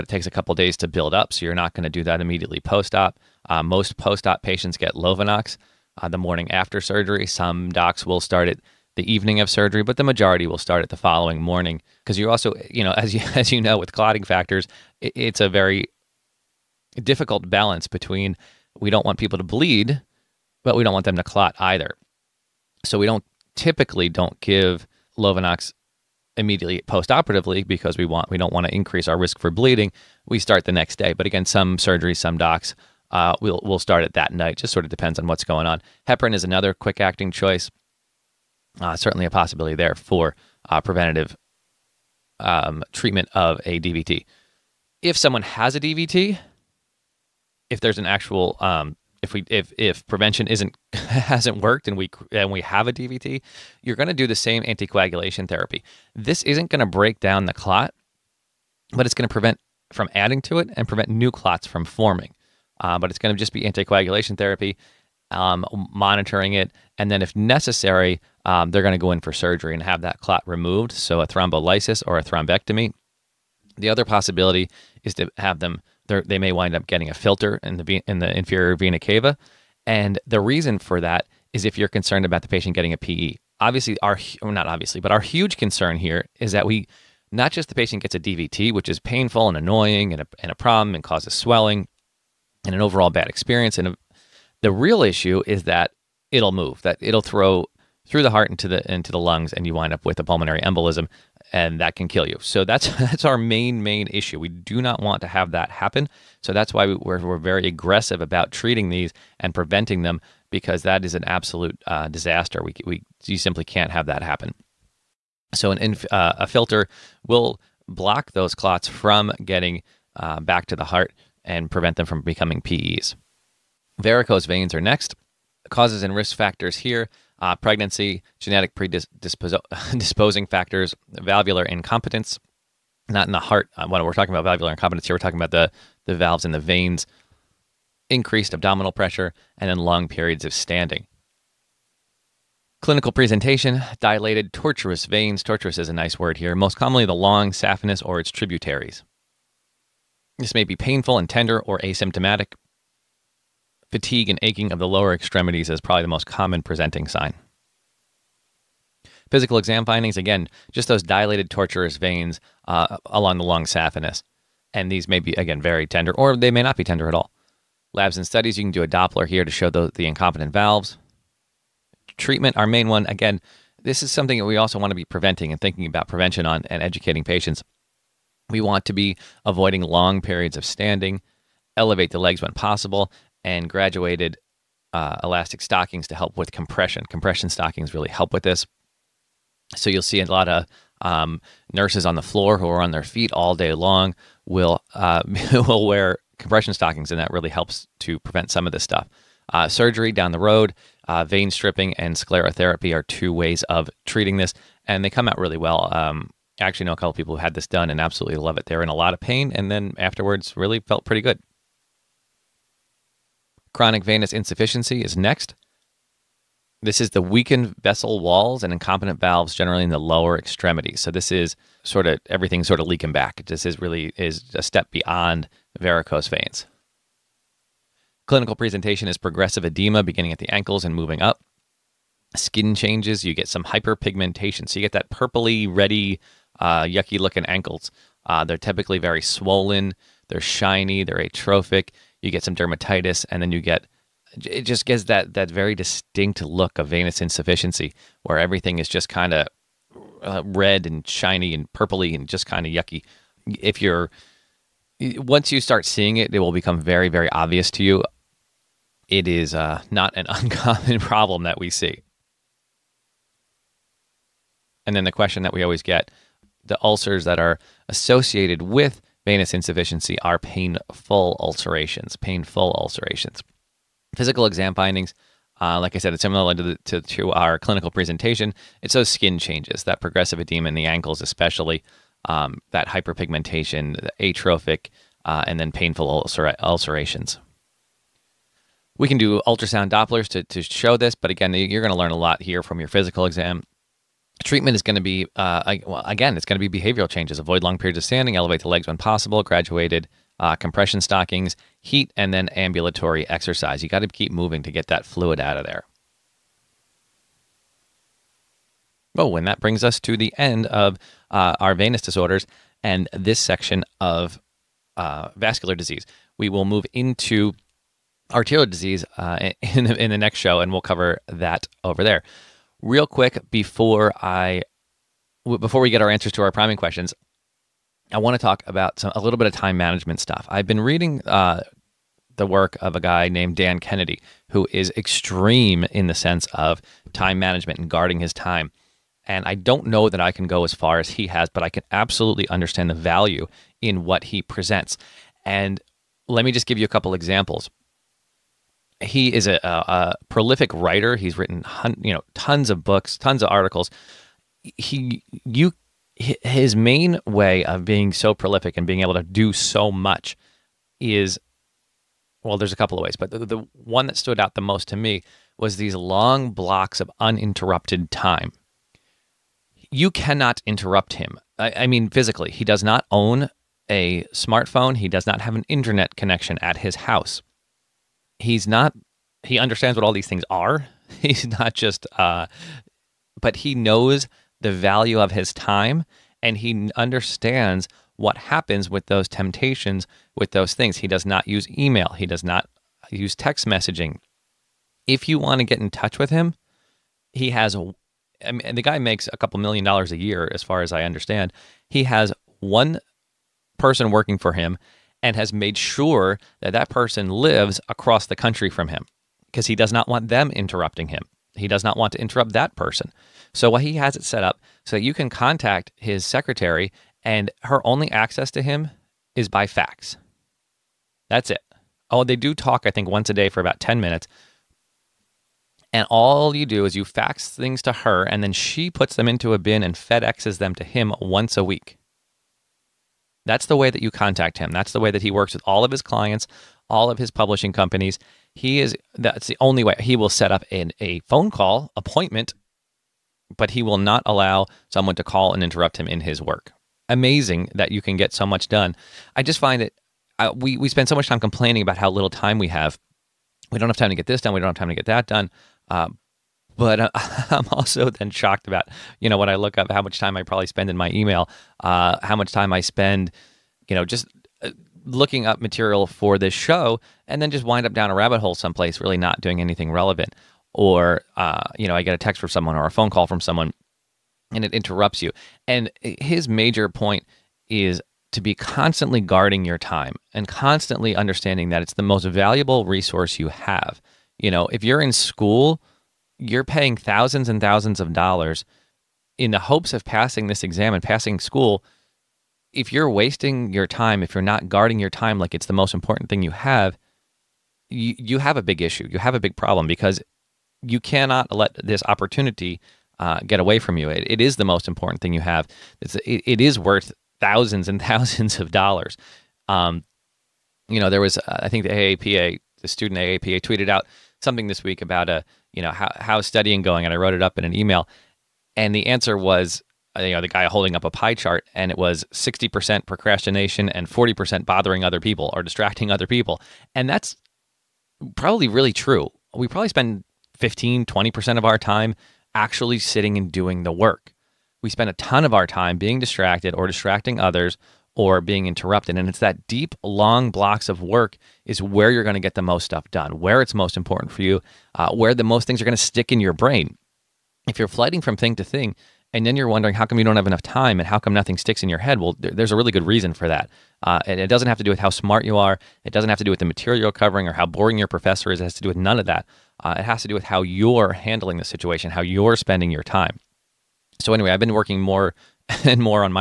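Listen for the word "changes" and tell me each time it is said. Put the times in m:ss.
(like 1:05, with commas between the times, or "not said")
3:52, 4:39, 4:57.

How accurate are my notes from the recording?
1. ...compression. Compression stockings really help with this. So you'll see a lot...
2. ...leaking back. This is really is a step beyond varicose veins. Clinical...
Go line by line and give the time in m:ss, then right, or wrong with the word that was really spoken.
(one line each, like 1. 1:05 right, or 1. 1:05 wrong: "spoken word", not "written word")
1. 3:06 right
2. 3:42 right.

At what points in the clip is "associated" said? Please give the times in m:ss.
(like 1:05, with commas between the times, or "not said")
4:27.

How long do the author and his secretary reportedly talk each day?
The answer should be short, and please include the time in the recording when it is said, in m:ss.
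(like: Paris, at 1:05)
about 10 minutes, at 7:03.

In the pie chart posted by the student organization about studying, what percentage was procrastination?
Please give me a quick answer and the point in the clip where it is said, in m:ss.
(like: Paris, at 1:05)
60%, at 8:42.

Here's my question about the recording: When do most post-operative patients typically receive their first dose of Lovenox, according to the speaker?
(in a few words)
the morning after surgery.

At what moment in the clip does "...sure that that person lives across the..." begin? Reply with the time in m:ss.
6:45.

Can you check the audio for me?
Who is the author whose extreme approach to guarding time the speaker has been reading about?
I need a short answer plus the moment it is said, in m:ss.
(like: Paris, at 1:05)
Dan Kennedy, at 5:33.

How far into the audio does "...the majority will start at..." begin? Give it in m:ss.
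0:09.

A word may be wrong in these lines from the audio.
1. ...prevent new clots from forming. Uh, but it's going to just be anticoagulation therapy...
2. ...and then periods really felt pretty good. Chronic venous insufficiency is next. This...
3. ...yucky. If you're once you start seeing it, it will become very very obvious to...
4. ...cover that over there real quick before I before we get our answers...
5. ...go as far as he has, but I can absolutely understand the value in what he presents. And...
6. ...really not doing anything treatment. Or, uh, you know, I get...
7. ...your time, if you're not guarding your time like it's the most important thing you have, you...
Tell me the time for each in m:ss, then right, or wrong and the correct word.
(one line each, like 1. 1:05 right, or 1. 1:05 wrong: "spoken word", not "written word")
1. 1:00 right
2. 3:29 wrong: "afterwards", not "periods"
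3. 4:12 right
4. 5:20 right
5. 5:40 right
6. 7:49 wrong: "relevant", not "treatment"
7. 8:13 right.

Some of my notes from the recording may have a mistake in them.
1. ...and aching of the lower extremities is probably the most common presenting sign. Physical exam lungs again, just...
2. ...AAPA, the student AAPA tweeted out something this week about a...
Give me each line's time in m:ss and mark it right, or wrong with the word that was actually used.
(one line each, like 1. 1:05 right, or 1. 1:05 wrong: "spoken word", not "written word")
1. 2:34 wrong: "findings", not "lungs"
2. 8:31 right.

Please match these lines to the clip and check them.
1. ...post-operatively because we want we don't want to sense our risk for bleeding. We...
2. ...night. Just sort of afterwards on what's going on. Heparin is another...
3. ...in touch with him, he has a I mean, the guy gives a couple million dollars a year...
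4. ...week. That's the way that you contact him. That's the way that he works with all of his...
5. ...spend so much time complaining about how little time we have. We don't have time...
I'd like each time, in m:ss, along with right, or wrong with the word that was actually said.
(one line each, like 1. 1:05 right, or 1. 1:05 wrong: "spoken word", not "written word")
1. 0:26 wrong: "increase", not "sense"
2. 0:34 wrong: "depends", not "afterwards"
3. 6:35 wrong: "makes", not "gives"
4. 7:11 right
5. 7:30 right.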